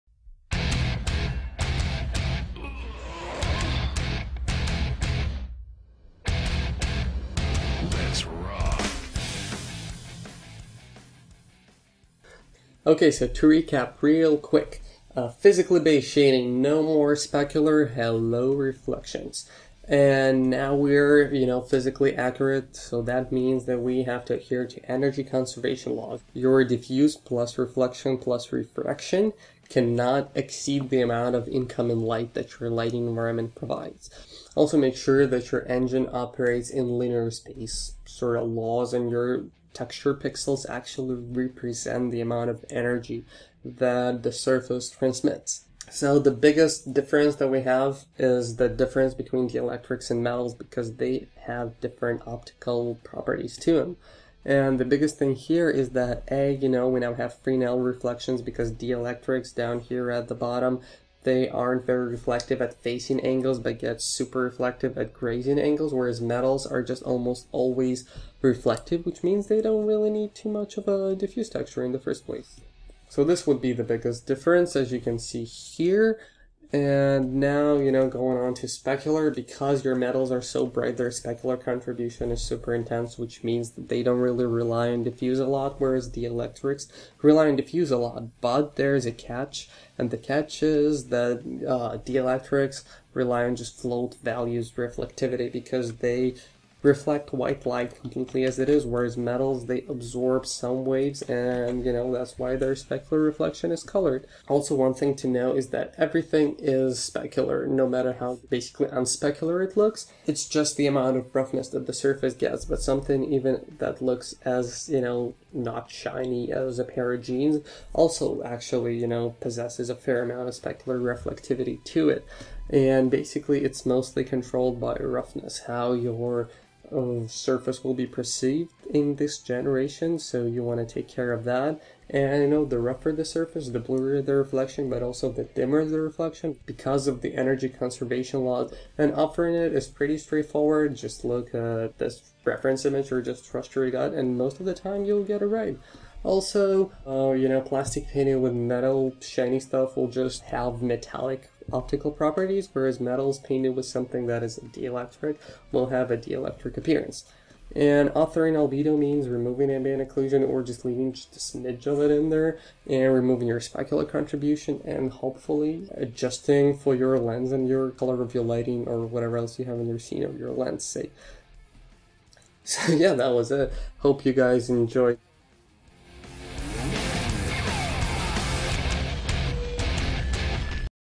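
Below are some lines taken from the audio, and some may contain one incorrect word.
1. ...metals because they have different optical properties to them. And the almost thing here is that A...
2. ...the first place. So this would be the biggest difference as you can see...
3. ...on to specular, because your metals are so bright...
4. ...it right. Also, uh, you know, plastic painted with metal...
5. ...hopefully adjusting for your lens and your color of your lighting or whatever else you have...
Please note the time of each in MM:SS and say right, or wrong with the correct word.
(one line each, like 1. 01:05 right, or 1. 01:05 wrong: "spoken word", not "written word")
1. 00:50 wrong: "biggest", not "almost"
2. 01:11 right
3. 01:18 right
4. 02:25 right
5. 02:45 right.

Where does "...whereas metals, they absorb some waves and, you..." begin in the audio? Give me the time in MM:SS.
01:38.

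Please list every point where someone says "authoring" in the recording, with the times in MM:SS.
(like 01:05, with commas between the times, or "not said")
02:19, 02:38.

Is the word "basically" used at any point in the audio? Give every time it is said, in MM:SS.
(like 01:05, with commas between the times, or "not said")
01:48, 02:03.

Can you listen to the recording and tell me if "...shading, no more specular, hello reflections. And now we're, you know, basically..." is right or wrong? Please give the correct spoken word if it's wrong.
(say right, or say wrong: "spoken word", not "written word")
wrong: "physically", not "basically".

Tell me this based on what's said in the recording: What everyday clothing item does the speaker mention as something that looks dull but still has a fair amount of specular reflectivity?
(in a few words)
A pair of jeans.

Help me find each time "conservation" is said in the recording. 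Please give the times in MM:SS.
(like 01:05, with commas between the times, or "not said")
00:25, 02:17.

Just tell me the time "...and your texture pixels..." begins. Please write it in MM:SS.
00:38.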